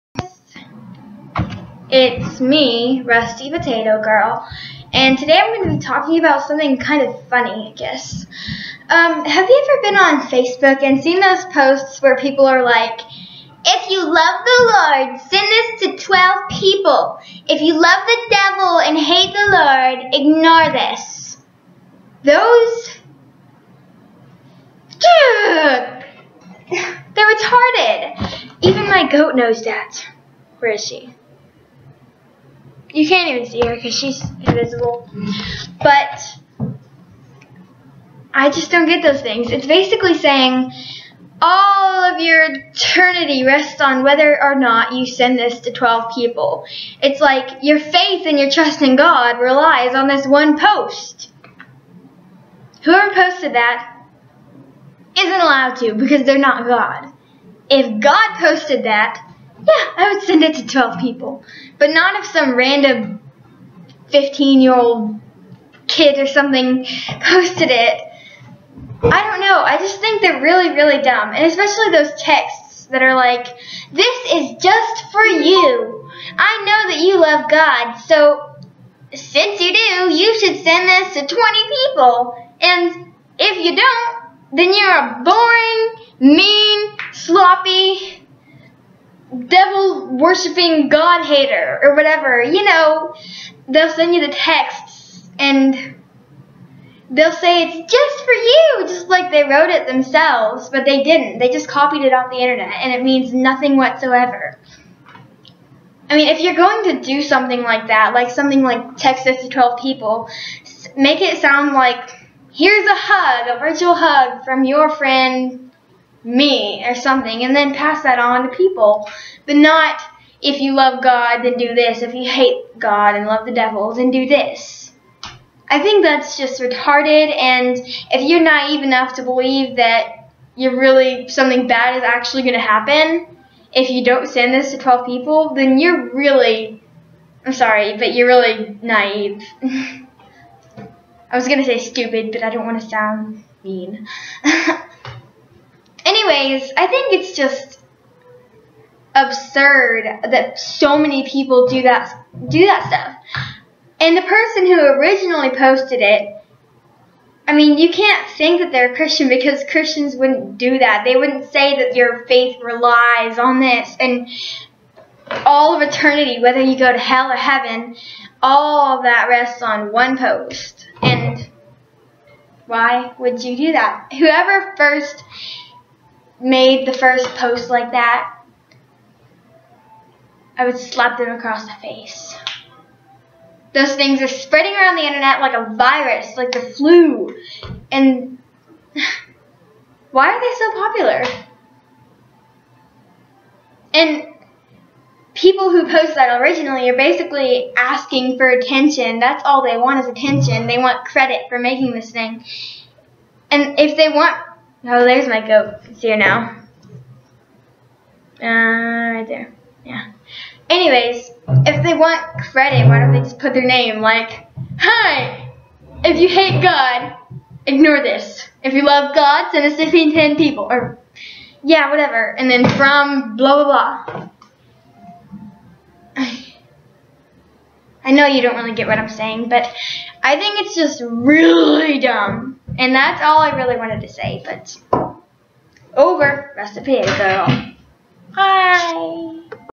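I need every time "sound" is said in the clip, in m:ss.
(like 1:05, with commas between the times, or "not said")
1:51, 2:22.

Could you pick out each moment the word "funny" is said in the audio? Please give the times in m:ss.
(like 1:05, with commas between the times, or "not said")
0:07.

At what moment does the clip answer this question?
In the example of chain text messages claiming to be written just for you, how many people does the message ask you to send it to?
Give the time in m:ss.
1:21.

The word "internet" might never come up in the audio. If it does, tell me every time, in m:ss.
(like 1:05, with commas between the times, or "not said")
1:42, 3:05.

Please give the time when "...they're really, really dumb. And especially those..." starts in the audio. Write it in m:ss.
1:10.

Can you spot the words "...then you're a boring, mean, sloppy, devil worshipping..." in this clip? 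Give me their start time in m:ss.
1:24.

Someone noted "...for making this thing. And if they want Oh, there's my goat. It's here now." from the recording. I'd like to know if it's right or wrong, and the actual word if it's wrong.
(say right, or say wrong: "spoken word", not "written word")
right.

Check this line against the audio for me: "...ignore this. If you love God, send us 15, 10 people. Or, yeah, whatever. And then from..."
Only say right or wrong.
right.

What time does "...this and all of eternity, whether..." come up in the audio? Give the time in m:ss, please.
2:43.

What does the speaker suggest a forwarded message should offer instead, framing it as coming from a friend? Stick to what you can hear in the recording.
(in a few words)
a virtual hug.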